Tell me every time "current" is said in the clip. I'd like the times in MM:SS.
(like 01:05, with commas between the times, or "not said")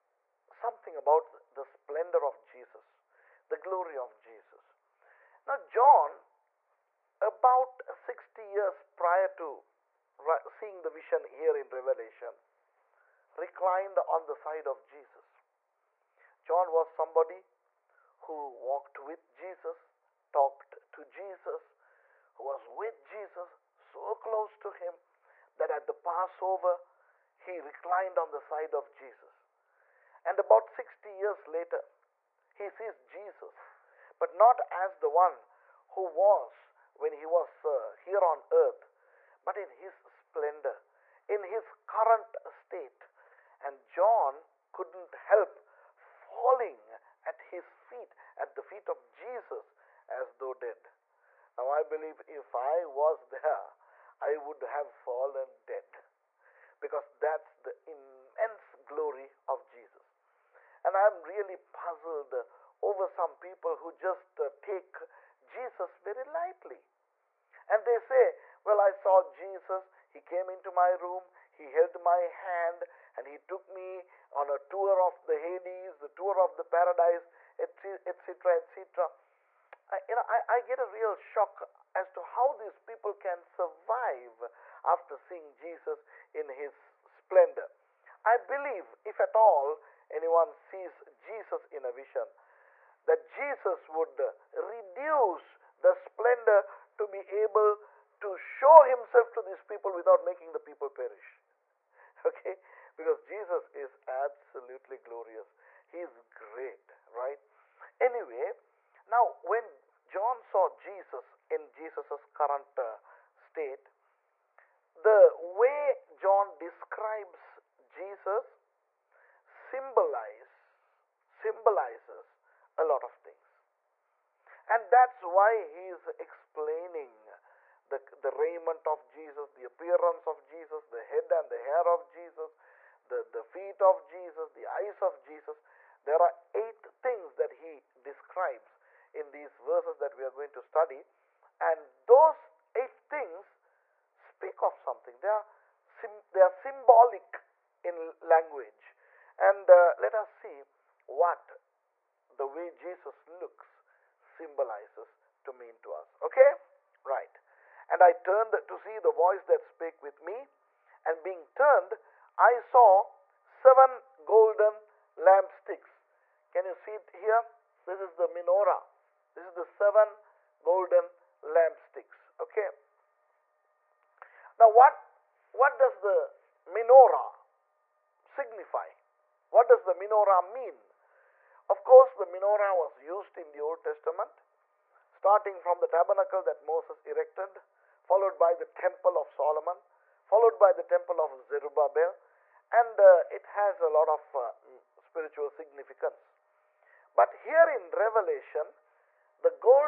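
00:41, 01:52.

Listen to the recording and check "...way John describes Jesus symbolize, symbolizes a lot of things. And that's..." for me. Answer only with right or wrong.
right.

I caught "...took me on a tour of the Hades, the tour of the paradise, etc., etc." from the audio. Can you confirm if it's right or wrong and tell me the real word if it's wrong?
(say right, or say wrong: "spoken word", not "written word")
right.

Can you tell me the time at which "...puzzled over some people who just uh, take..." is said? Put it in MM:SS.
01:01.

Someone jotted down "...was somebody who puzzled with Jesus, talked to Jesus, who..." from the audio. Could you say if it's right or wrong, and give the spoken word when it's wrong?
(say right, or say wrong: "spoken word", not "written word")
wrong: "walked", not "puzzled".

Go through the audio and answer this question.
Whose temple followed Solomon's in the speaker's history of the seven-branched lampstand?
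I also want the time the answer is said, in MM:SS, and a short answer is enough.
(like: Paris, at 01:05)
Zerubbabel, at 03:11.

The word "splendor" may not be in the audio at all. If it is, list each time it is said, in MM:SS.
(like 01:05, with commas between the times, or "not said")
00:01, 00:39, 01:27, 01:35.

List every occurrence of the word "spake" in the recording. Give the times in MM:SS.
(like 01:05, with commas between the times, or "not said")
02:39.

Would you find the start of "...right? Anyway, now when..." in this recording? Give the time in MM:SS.
01:47.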